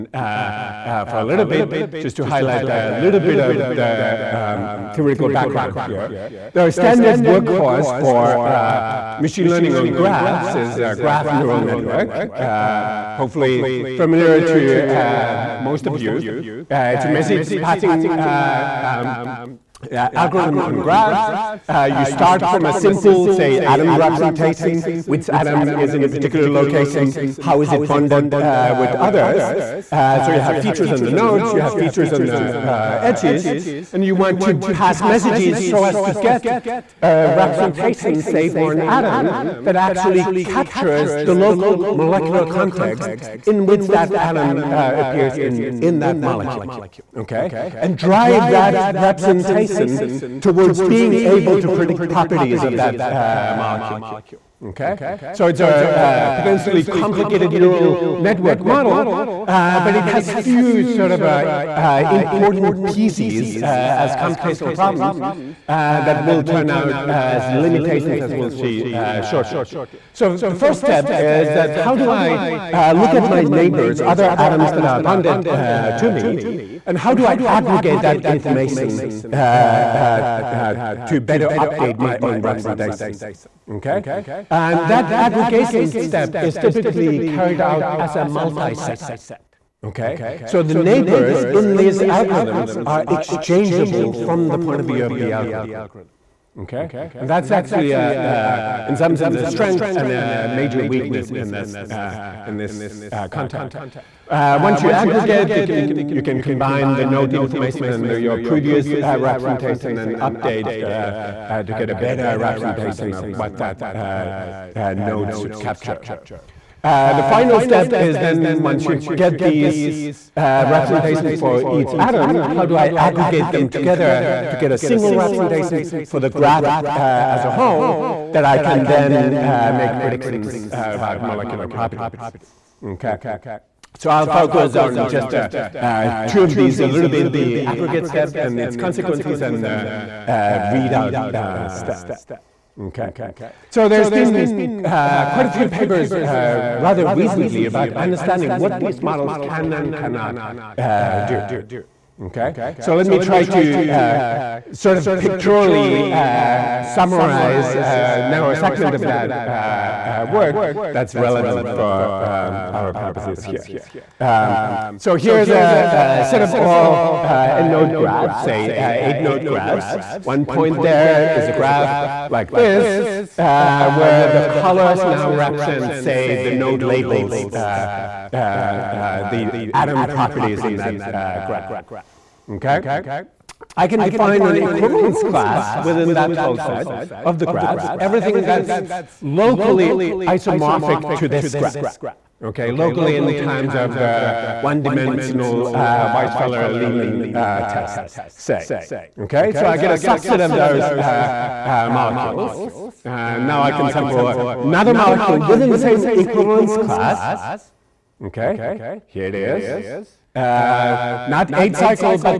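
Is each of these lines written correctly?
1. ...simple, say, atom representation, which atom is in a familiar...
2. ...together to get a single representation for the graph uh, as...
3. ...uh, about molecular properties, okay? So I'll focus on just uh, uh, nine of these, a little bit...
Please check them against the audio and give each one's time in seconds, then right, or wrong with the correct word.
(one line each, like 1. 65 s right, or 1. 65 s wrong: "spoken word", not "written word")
1. 22 s wrong: "particular", not "familiar"
2. 123 s right
3. 130 s wrong: "two", not "nine".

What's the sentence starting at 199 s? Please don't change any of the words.
Okay, so I get a subset of those uh, uh, molecules.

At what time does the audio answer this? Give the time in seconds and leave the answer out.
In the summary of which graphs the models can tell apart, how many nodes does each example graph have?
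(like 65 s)
168 s.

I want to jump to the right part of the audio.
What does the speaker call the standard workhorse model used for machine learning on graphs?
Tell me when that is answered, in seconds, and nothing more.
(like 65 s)
10 s.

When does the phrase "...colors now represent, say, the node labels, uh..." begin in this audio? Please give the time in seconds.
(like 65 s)
174 s.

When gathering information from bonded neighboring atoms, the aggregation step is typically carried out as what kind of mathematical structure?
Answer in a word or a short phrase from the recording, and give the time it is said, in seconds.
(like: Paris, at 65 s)
a multi-set, at 88 s.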